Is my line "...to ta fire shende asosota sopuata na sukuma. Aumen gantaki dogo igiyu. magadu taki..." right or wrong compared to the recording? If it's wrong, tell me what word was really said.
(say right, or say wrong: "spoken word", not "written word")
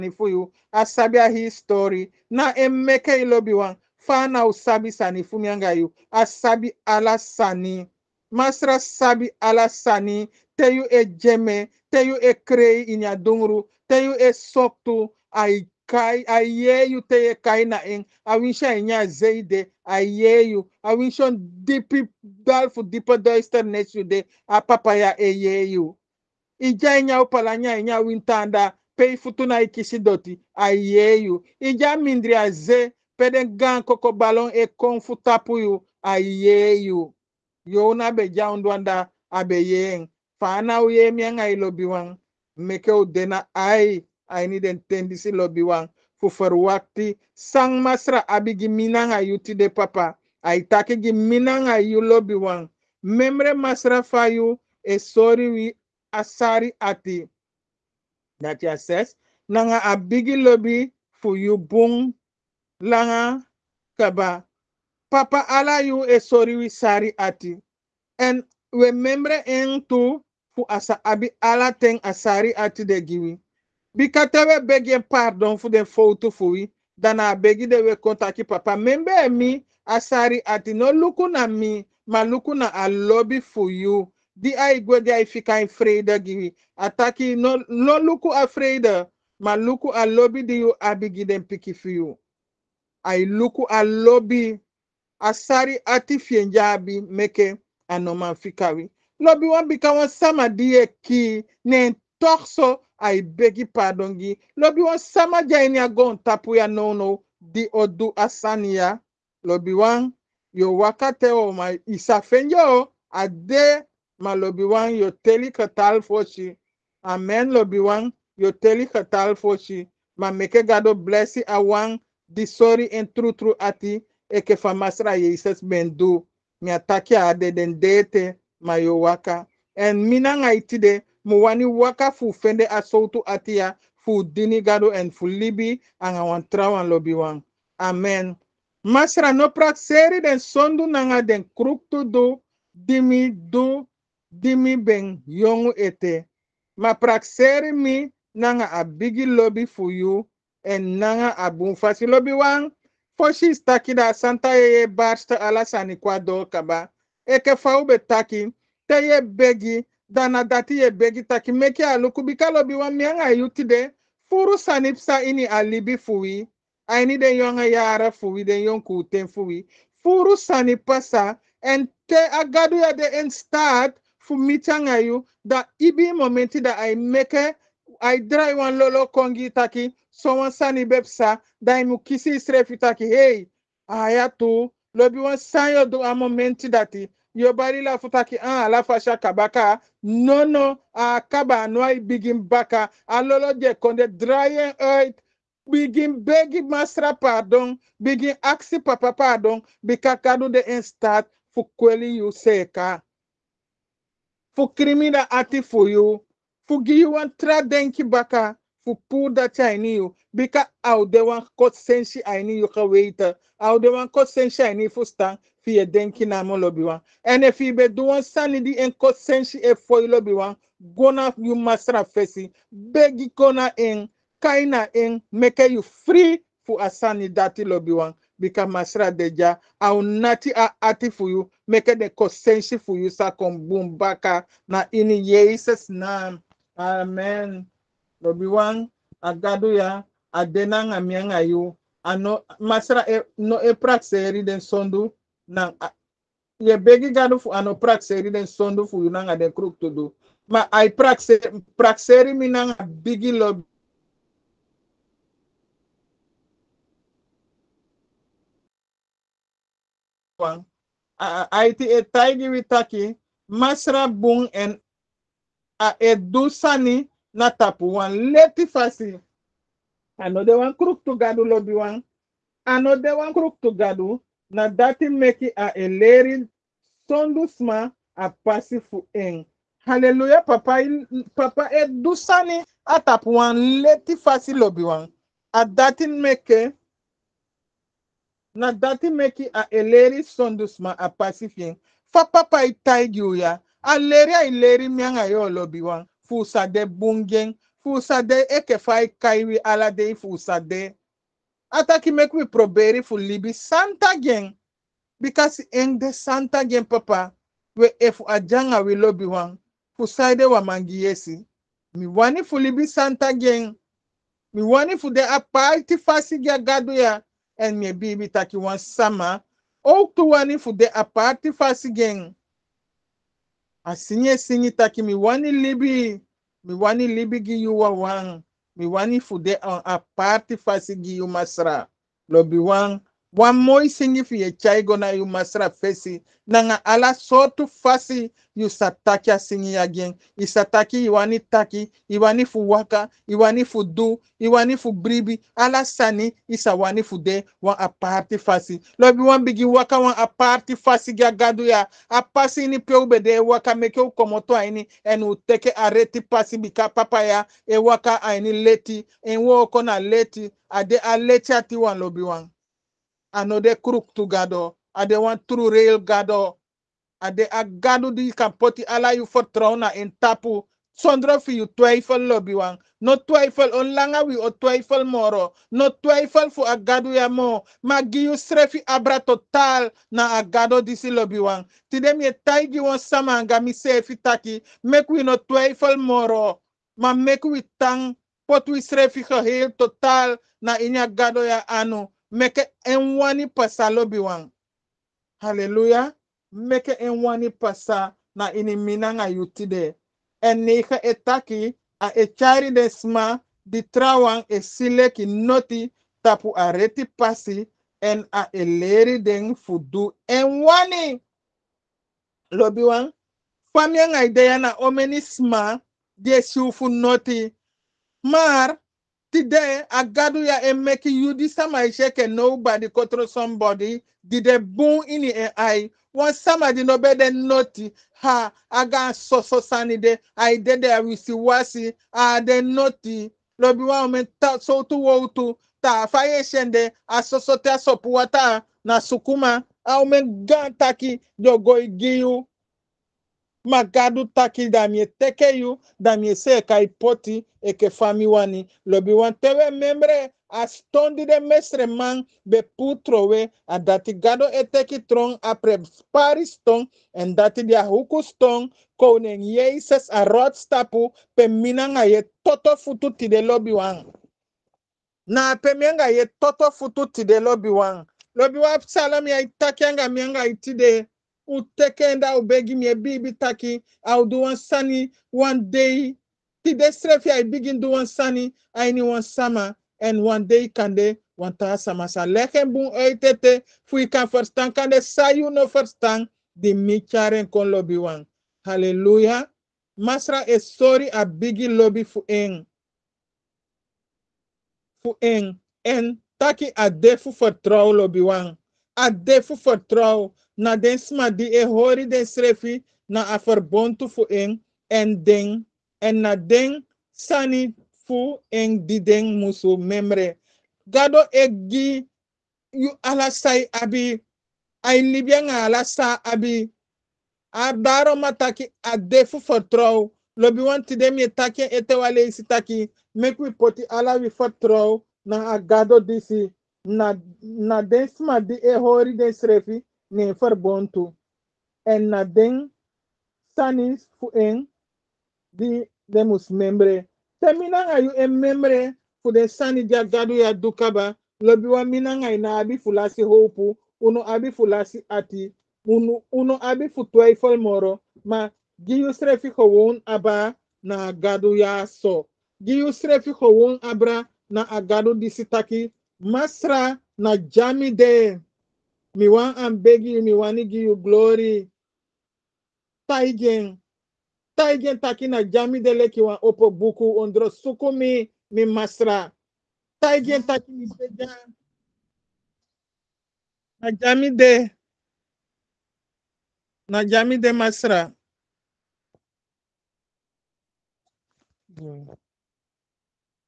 right.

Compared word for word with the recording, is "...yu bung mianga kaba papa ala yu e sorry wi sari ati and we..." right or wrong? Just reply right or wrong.
wrong.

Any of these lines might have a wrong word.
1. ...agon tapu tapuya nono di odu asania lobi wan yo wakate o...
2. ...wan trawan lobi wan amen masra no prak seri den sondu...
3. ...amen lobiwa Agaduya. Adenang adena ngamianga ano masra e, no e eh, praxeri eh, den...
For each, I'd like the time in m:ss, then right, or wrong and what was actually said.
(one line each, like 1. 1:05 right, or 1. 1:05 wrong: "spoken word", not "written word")
1. 1:45 right
2. 2:16 right
3. 3:56 right.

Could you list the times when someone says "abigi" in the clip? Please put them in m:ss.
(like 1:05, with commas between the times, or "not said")
0:48, 0:59.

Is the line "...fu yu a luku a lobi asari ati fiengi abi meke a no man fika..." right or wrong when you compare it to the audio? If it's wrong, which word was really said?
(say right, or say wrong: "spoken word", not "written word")
right.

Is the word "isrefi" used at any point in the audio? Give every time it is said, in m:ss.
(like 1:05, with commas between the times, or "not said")
3:02.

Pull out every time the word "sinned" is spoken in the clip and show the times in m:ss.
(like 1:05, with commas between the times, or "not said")
not said.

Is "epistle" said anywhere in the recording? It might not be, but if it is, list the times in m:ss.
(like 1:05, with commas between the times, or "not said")
not said.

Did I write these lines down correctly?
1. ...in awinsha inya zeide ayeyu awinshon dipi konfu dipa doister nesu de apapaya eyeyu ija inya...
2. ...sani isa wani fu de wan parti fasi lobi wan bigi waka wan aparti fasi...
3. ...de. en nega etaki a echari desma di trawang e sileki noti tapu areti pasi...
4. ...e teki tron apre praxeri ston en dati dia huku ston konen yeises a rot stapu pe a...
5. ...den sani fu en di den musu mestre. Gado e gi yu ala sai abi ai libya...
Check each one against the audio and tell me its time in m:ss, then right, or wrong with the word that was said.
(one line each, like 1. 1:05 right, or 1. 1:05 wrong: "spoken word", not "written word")
1. 0:17 wrong: "dalfu", not "konfu"
2. 5:45 wrong: "aparti", not "parti"
3. 6:39 right
4. 7:34 wrong: "spari", not "praxeri"
5. 8:26 wrong: "memre", not "mestre".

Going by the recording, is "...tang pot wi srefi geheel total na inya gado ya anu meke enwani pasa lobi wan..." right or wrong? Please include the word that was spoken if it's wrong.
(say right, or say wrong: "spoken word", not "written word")
right.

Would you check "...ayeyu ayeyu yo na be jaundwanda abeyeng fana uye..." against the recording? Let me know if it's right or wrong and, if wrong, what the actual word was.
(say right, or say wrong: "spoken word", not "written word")
wrong: "tapuyu", not "ayeyu".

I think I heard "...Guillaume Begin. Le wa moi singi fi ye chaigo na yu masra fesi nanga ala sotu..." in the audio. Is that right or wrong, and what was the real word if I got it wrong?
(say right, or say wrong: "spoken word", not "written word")
wrong: "Masra", not "Begin".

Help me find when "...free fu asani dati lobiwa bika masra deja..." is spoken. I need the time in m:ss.
3:45.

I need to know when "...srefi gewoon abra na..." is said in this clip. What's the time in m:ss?
9:12.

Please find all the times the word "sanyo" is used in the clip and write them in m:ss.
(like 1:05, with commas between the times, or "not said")
3:05.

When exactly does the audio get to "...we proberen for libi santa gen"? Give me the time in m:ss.
5:02.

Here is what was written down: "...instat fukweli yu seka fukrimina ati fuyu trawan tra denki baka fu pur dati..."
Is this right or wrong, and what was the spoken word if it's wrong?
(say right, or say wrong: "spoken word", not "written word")
wrong: "fugiwan", not "trawan".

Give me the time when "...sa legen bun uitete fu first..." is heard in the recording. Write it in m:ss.
8:02.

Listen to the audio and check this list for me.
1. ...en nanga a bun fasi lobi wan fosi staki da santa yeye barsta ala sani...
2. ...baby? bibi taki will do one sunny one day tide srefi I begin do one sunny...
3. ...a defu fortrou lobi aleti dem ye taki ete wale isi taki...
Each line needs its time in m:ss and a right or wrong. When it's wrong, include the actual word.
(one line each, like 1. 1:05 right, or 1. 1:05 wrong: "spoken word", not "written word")
1. 2:30 right
2. 7:52 right
3. 8:38 wrong: "wanti", not "aleti".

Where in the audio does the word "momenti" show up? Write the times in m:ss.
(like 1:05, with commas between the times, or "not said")
2:56, 3:06.